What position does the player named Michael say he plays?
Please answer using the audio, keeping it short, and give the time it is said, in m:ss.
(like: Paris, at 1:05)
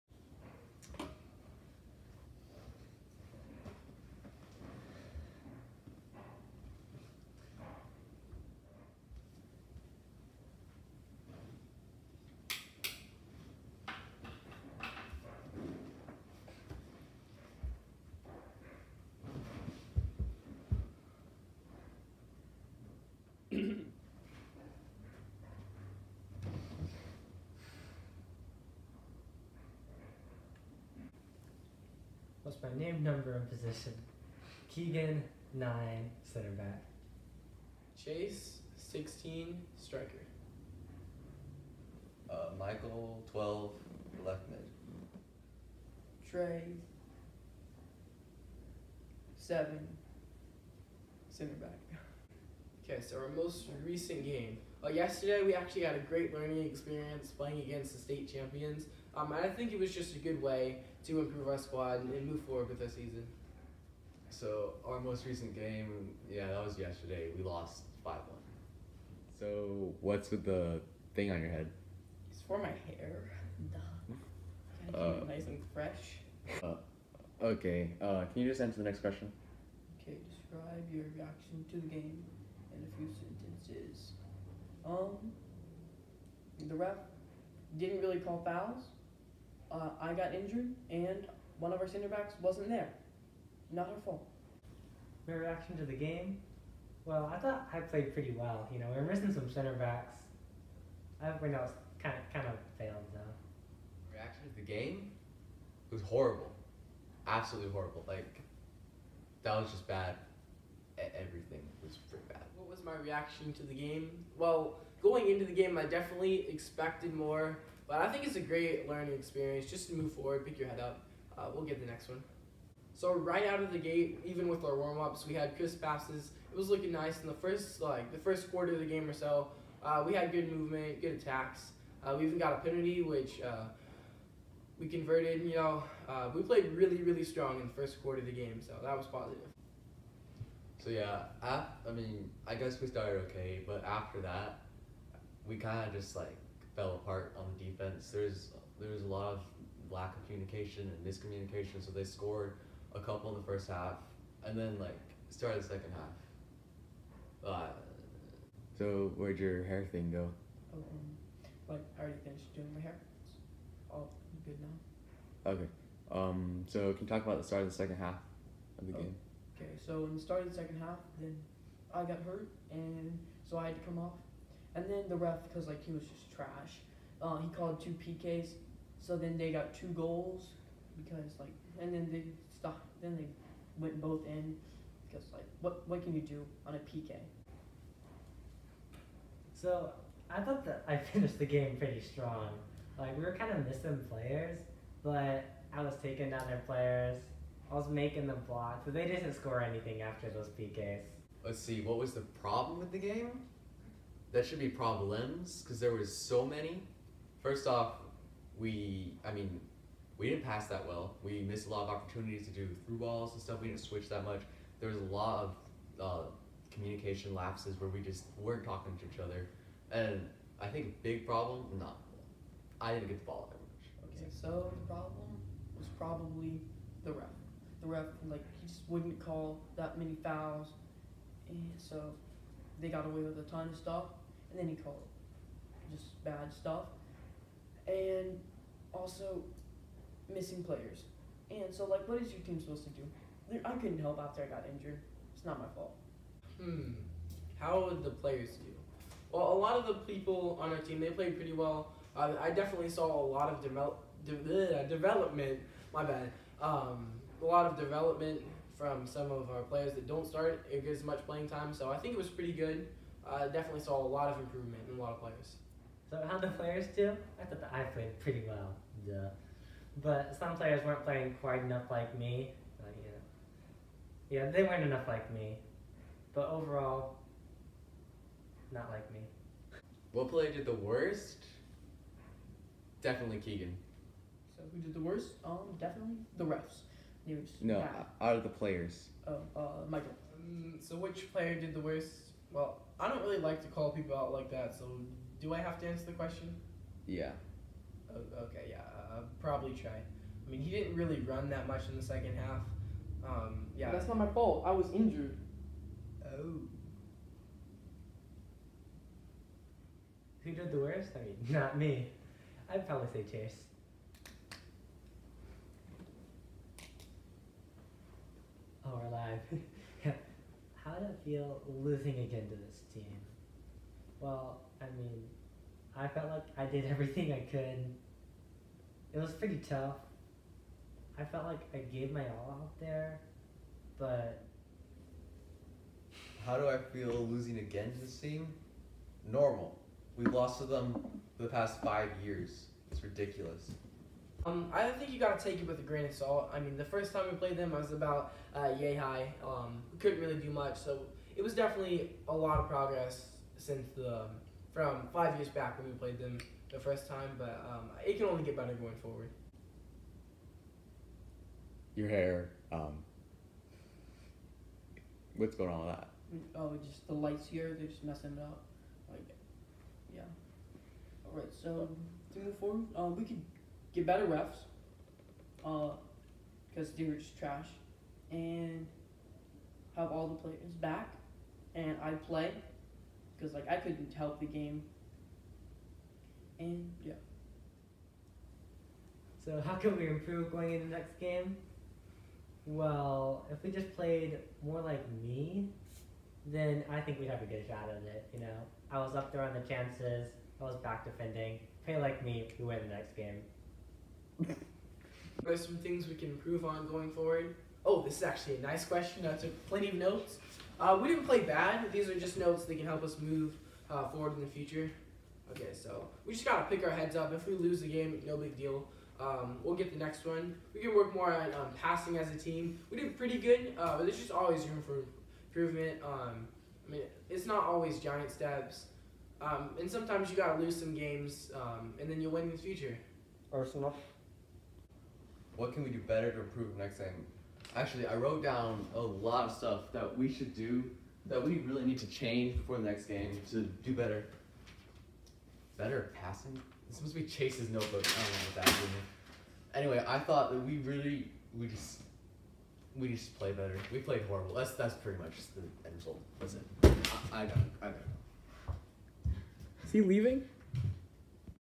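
Left mid, at 0:44.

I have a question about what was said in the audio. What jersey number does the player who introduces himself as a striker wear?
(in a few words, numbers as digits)
16.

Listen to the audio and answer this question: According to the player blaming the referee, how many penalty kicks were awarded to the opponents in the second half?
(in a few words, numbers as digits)
2.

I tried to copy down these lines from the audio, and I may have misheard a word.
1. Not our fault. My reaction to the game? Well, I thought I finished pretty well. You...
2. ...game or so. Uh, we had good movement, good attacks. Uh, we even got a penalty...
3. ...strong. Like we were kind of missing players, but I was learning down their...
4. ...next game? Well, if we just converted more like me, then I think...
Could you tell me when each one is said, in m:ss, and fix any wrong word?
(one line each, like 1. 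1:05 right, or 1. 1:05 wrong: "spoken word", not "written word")
1. 1:33 wrong: "played", not "finished"
2. 2:08 right
3. 3:12 wrong: "taking", not "learning"
4. 6:30 wrong: "played", not "converted".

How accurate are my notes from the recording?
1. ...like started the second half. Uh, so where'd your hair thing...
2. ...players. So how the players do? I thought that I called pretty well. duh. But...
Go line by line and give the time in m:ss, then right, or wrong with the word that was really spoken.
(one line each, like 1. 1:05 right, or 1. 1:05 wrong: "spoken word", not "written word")
1. 2:34 right
2. 4:25 wrong: "played", not "called".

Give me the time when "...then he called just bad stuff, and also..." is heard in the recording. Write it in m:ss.
3:54.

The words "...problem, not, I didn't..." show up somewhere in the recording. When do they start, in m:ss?
3:41.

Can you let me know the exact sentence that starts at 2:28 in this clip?
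There's there was a lot of lack of communication and miscommunication.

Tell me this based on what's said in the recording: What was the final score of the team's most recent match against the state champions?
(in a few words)
5-1.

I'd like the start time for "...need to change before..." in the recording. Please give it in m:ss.
7:21.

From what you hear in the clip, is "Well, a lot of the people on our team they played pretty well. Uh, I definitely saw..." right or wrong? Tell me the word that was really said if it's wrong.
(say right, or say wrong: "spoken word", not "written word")
right.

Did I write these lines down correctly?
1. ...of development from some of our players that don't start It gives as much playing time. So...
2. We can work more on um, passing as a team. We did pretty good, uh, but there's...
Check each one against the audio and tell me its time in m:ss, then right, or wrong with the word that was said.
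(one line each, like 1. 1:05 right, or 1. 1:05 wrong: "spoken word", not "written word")
1. 4:17 right
2. 7:00 right.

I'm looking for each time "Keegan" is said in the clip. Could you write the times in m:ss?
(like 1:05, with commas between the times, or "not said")
0:34, 4:43.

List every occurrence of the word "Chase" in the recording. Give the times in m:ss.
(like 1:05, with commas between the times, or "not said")
0:38, 5:13, 7:27.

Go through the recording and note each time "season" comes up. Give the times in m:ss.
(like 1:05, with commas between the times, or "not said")
1:02.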